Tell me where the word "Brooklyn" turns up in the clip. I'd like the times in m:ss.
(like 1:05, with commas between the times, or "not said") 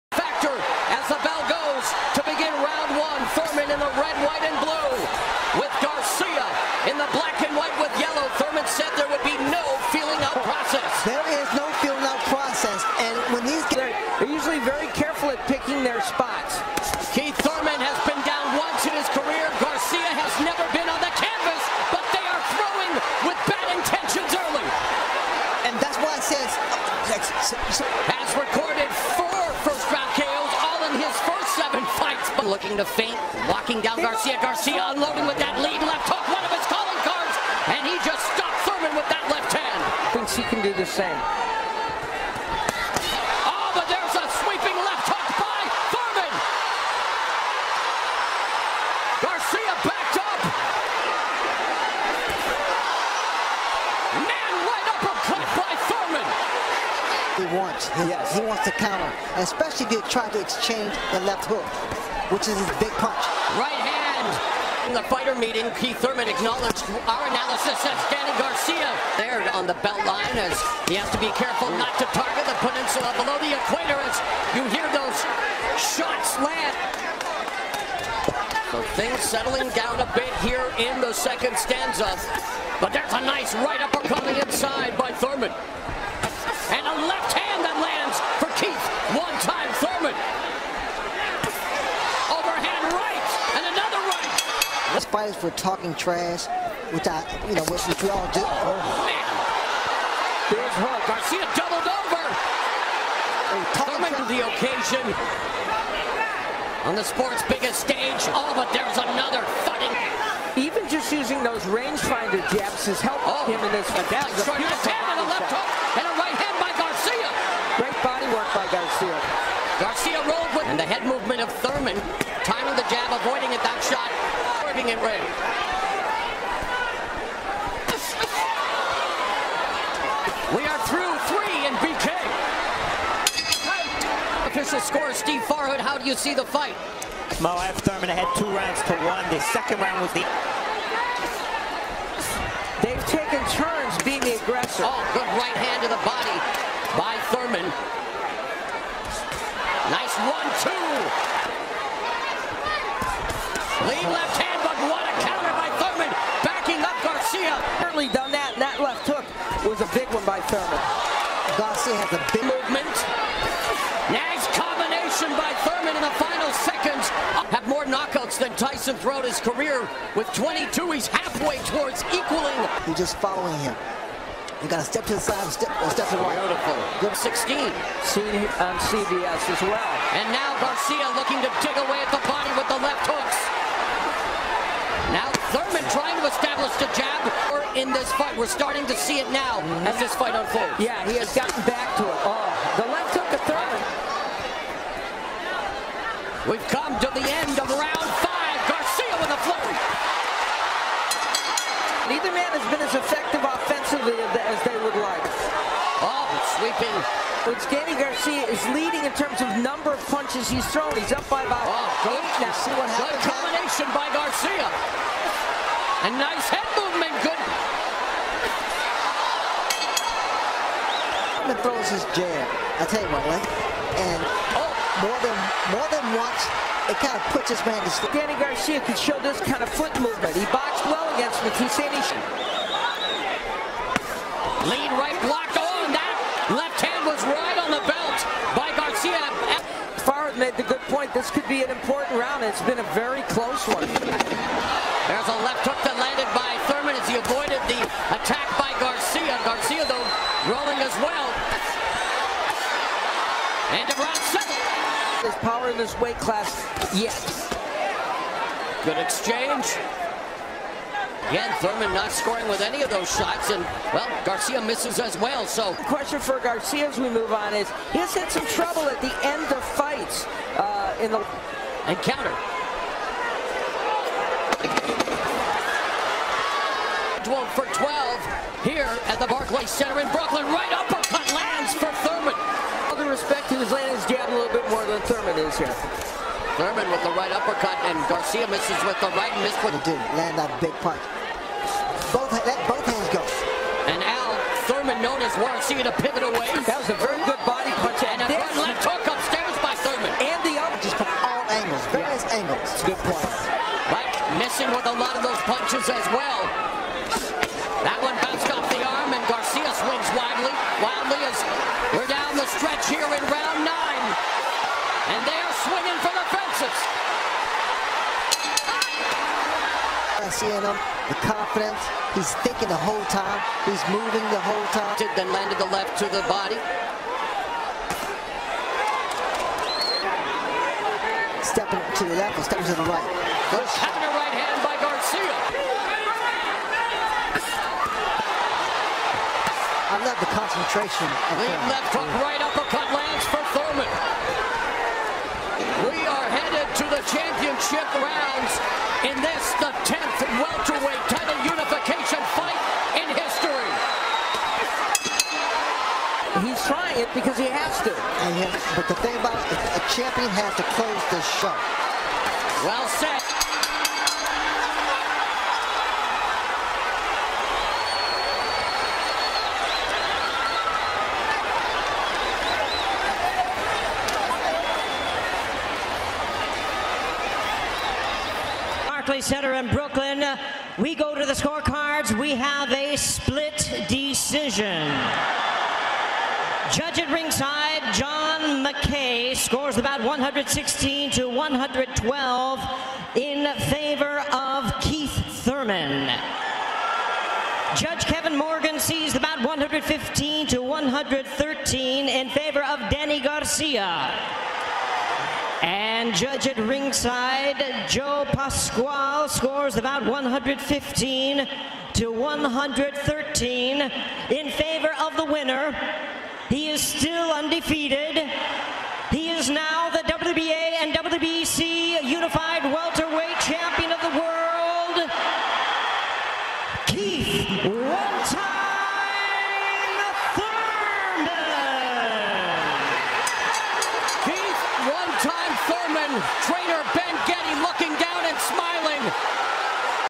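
4:40, 6:19.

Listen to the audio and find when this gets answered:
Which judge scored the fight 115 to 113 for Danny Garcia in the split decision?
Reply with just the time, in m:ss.
6:38.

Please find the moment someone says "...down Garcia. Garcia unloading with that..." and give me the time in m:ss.
0:33.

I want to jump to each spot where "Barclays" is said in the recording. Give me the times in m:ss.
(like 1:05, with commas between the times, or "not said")
4:39, 6:18.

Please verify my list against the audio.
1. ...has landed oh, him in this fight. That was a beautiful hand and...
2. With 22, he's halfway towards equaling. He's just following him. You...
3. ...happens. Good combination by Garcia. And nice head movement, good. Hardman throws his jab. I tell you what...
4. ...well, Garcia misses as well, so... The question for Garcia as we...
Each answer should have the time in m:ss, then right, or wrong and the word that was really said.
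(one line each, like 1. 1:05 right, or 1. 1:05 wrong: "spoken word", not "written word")
1. 1:52 wrong: "helped", not "landed"
2. 2:50 right
3. 3:32 right
4. 4:23 right.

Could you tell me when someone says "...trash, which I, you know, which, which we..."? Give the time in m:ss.
1:35.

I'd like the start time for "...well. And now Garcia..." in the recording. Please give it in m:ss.
2:59.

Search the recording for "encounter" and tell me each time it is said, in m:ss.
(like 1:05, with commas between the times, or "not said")
4:31.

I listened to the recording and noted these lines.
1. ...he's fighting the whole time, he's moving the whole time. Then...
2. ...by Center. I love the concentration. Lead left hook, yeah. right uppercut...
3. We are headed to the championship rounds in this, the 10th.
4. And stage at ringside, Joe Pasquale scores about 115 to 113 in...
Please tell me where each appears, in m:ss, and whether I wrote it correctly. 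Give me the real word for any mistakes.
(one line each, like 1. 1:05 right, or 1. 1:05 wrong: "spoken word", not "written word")
1. 5:22 wrong: "thinking", not "fighting"
2. 5:34 wrong: "Garcia", not "Center"
3. 5:45 right
4. 6:45 wrong: "judge", not "stage".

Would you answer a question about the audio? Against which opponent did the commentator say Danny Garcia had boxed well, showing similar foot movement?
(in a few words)
Matisani.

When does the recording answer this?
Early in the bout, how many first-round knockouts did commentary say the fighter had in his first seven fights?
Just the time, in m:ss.
0:29.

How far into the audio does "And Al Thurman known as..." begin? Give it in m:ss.
4:53.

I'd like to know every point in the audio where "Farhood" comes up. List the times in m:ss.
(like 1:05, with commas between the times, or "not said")
2:15, 4:00.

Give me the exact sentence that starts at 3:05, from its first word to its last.
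Thurman trying to establish the jab in this fight.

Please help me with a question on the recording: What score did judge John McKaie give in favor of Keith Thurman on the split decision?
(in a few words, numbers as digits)
116-112.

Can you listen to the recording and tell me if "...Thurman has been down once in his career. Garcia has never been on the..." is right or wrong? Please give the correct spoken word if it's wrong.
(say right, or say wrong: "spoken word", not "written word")
right.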